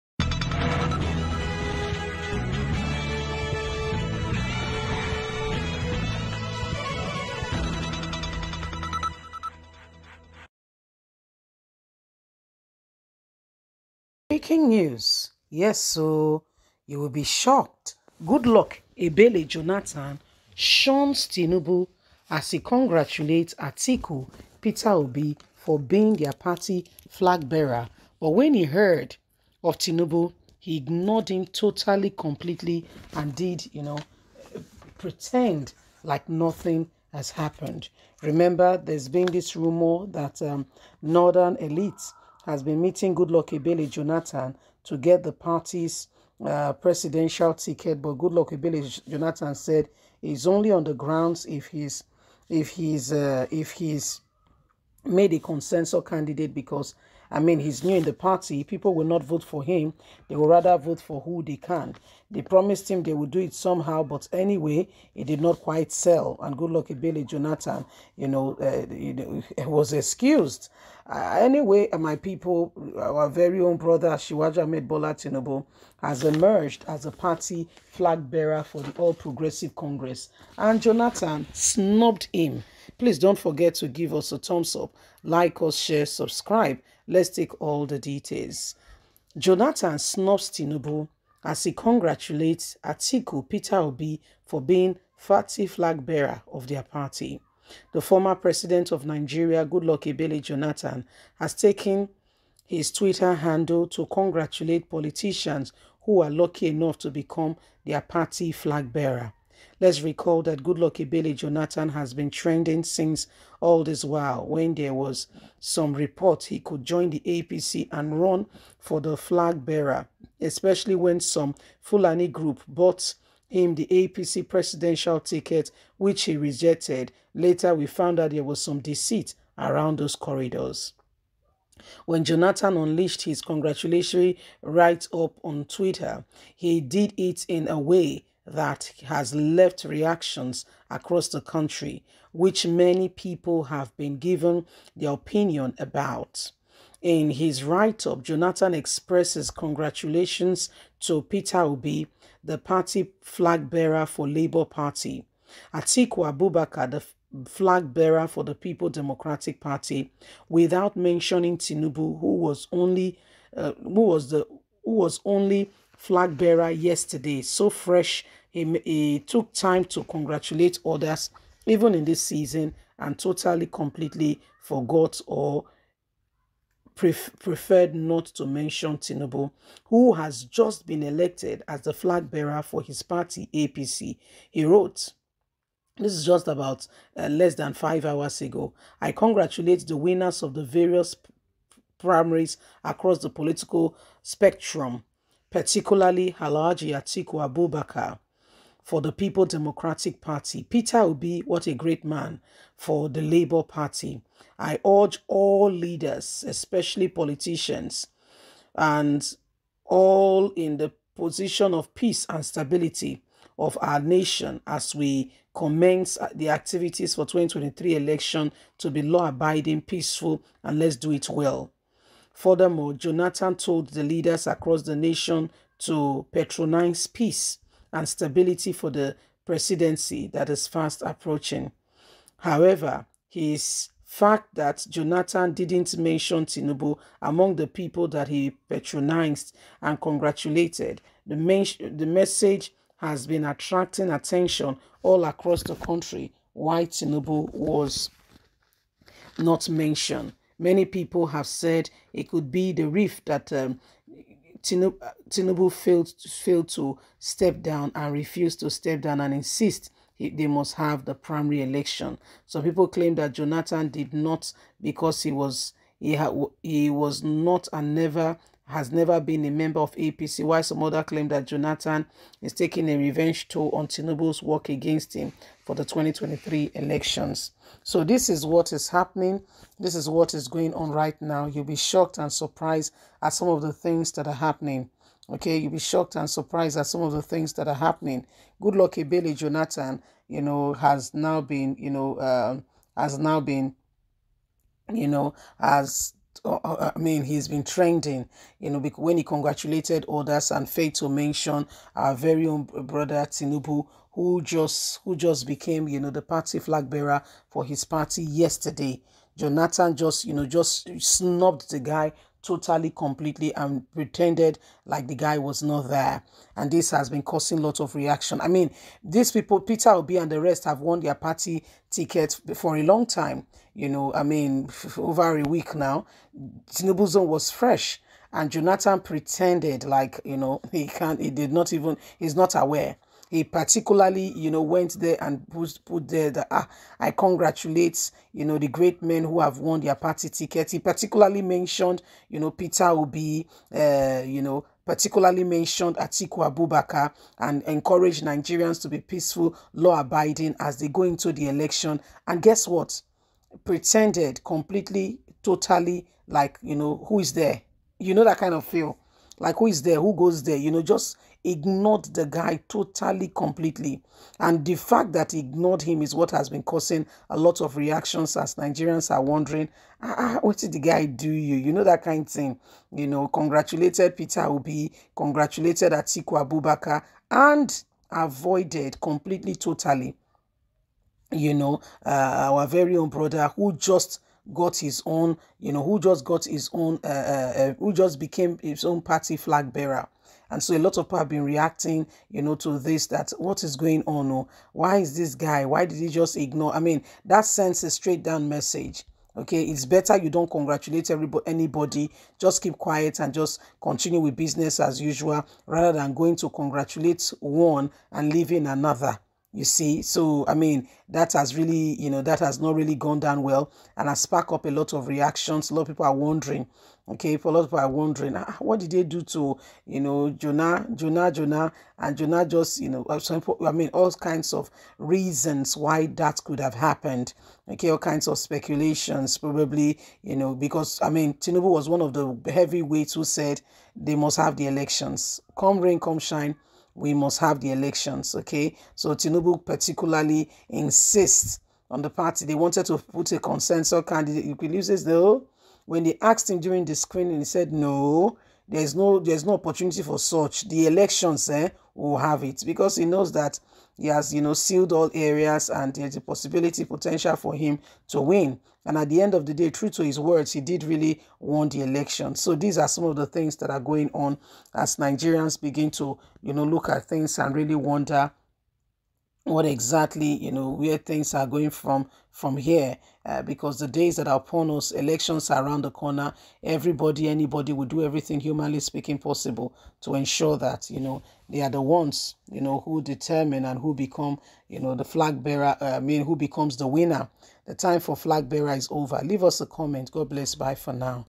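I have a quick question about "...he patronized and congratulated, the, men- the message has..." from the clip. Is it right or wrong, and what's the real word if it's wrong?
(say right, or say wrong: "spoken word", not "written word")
right.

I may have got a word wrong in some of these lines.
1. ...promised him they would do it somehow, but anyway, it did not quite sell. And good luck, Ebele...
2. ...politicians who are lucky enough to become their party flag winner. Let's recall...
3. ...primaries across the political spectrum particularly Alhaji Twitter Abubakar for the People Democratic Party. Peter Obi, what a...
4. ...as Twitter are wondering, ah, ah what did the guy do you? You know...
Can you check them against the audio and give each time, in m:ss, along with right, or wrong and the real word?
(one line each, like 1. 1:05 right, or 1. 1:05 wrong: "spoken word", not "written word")
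1. 1:02 right
2. 1:44 wrong: "bearer", not "winner"
3. 3:11 wrong: "Atiku", not "Twitter"
4. 6:08 wrong: "Nigerians", not "Twitter".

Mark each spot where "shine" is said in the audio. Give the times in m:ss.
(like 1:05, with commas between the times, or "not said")
7:16.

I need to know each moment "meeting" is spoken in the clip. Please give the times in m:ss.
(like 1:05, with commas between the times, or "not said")
0:42.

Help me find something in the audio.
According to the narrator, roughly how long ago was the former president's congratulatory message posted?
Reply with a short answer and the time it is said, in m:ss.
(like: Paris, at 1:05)
less than five hours ago, at 3:07.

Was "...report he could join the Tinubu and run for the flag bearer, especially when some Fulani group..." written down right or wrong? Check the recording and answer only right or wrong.
wrong.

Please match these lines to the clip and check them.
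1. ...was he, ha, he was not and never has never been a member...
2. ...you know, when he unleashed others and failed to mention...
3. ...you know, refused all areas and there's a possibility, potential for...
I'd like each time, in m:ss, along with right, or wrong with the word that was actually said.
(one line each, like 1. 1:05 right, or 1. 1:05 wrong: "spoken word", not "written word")
1. 4:25 right
2. 4:58 wrong: "congratulated", not "unleashed"
3. 7:34 wrong: "sealed", not "refused".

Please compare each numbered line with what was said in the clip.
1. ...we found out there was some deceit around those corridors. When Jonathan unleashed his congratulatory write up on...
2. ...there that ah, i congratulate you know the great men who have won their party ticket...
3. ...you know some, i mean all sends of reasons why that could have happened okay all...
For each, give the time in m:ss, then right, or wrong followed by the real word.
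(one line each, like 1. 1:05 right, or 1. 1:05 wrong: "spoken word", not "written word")
1. 2:07 right
2. 5:36 right
3. 7:02 wrong: "kinds", not "sends".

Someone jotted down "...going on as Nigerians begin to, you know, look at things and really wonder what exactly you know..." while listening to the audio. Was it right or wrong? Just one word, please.
right.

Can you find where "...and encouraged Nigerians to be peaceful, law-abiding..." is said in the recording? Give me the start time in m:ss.
5:47.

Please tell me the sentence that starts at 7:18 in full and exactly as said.
Okay, so Tinubu particularly insists on the party.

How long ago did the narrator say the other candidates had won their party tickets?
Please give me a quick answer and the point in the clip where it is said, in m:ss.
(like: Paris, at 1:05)
over a week, at 5:24.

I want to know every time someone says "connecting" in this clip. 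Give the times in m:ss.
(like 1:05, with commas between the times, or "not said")
not said.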